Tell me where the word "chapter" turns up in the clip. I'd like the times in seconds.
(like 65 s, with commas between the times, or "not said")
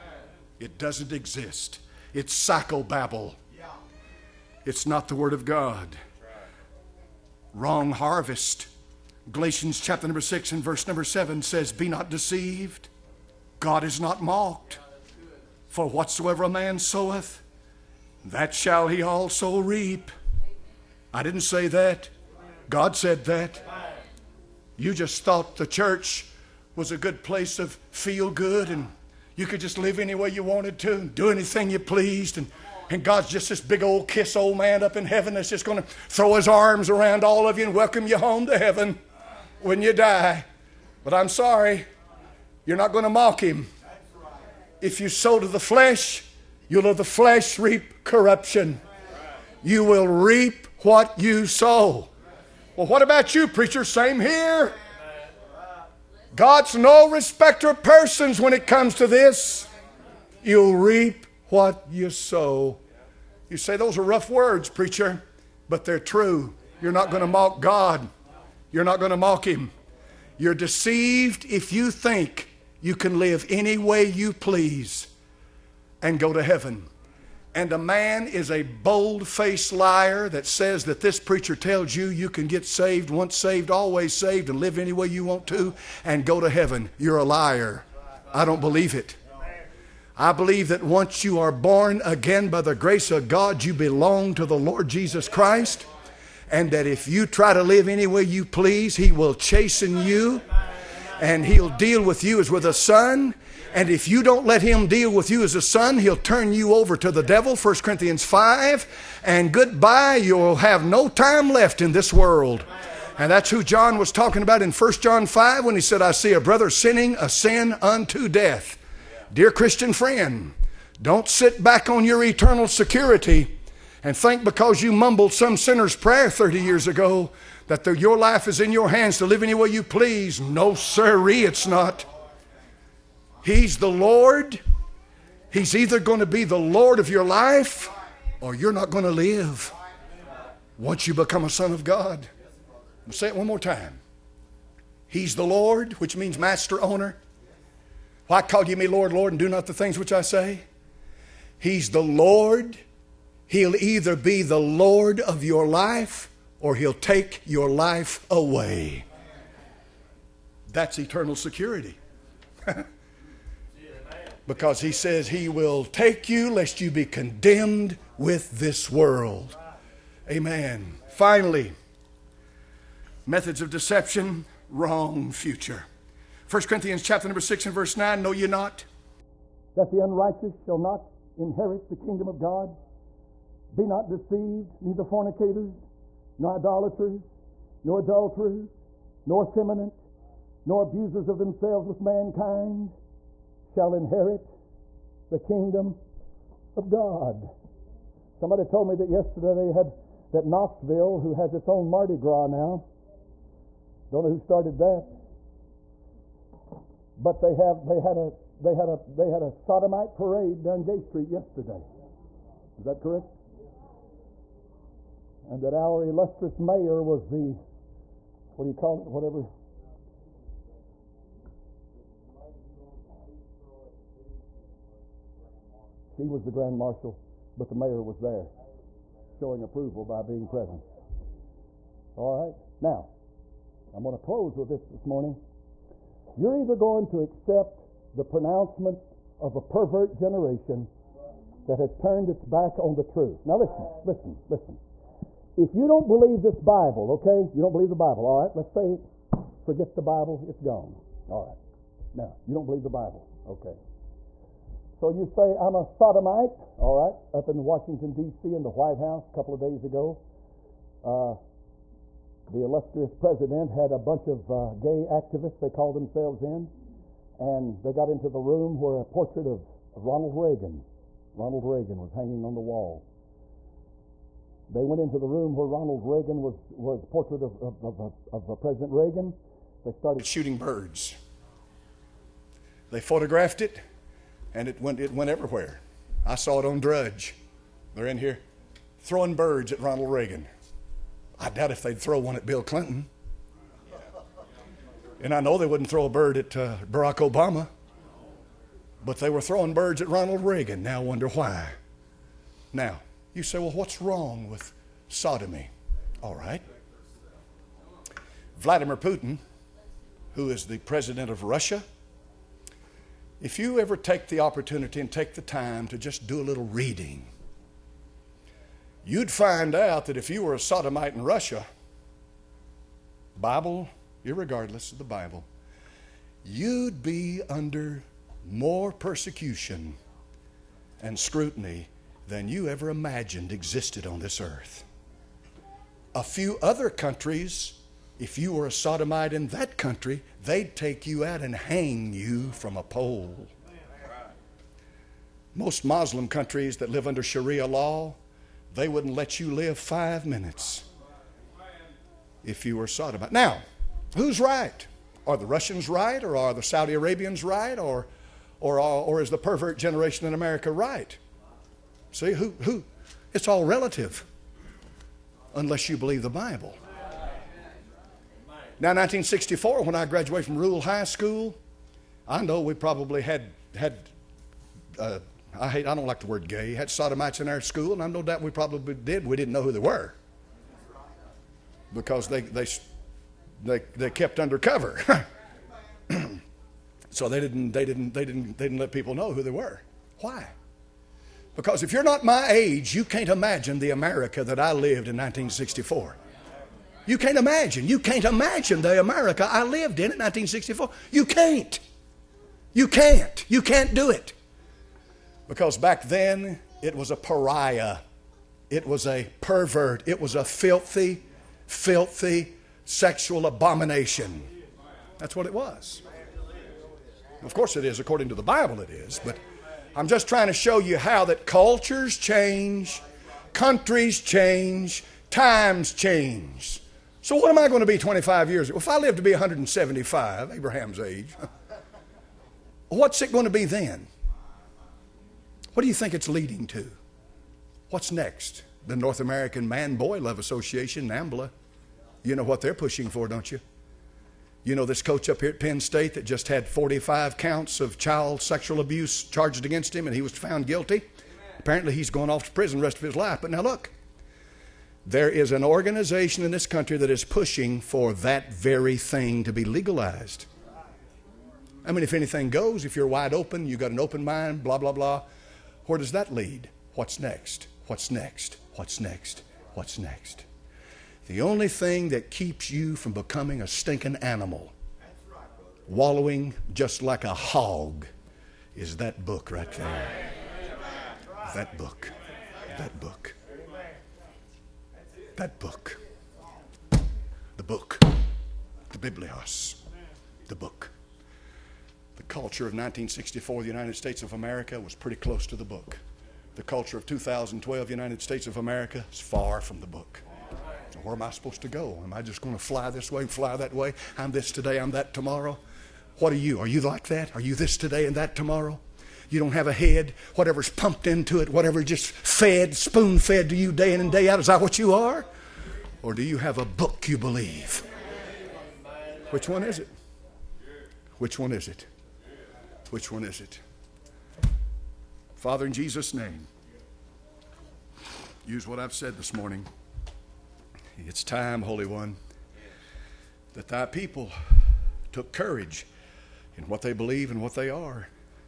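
9 s, 177 s.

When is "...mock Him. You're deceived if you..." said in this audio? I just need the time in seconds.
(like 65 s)
69 s.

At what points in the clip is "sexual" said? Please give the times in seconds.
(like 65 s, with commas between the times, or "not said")
412 s, 448 s.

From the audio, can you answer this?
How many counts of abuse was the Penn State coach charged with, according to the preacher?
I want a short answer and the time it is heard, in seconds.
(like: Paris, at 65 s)
45, at 446 s.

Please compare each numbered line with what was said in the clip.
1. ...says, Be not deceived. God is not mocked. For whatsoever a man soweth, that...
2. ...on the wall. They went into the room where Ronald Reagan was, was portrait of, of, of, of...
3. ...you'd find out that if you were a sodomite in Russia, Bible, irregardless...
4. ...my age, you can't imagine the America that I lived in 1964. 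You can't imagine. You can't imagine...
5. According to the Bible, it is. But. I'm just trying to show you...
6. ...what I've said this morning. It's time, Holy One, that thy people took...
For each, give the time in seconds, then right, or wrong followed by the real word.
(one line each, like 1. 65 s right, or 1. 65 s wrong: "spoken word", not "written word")
1. 11 s right
2. 272 s right
3. 319 s right
4. 392 s right
5. 417 s right
6. 528 s right.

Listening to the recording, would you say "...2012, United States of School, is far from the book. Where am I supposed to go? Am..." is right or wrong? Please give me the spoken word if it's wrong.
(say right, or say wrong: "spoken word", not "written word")
wrong: "America", not "School".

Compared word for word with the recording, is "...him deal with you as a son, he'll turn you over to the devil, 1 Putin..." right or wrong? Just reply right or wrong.
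wrong.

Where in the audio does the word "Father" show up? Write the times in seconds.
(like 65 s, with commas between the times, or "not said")
525 s.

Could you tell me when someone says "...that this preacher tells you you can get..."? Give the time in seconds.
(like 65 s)
80 s.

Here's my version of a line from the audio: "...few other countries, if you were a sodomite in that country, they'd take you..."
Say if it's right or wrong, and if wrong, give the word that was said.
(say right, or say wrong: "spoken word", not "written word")
right.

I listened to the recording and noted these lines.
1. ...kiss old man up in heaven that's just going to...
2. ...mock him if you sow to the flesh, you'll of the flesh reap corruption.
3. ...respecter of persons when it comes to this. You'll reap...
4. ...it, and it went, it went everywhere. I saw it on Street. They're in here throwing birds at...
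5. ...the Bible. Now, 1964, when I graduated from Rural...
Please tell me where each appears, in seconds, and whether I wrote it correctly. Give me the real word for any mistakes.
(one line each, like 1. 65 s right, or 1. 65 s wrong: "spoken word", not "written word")
1. 34 s right
2. 43 s right
3. 57 s right
4. 283 s wrong: "Drudge", not "Street"
5. 366 s right.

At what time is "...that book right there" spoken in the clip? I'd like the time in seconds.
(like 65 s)
478 s.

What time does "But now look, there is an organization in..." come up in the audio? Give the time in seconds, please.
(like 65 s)
453 s.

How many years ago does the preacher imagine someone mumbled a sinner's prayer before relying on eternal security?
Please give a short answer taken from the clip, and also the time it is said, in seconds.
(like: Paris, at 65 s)
30, at 126 s.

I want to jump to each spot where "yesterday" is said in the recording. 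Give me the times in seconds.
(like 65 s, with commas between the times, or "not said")
199 s, 211 s.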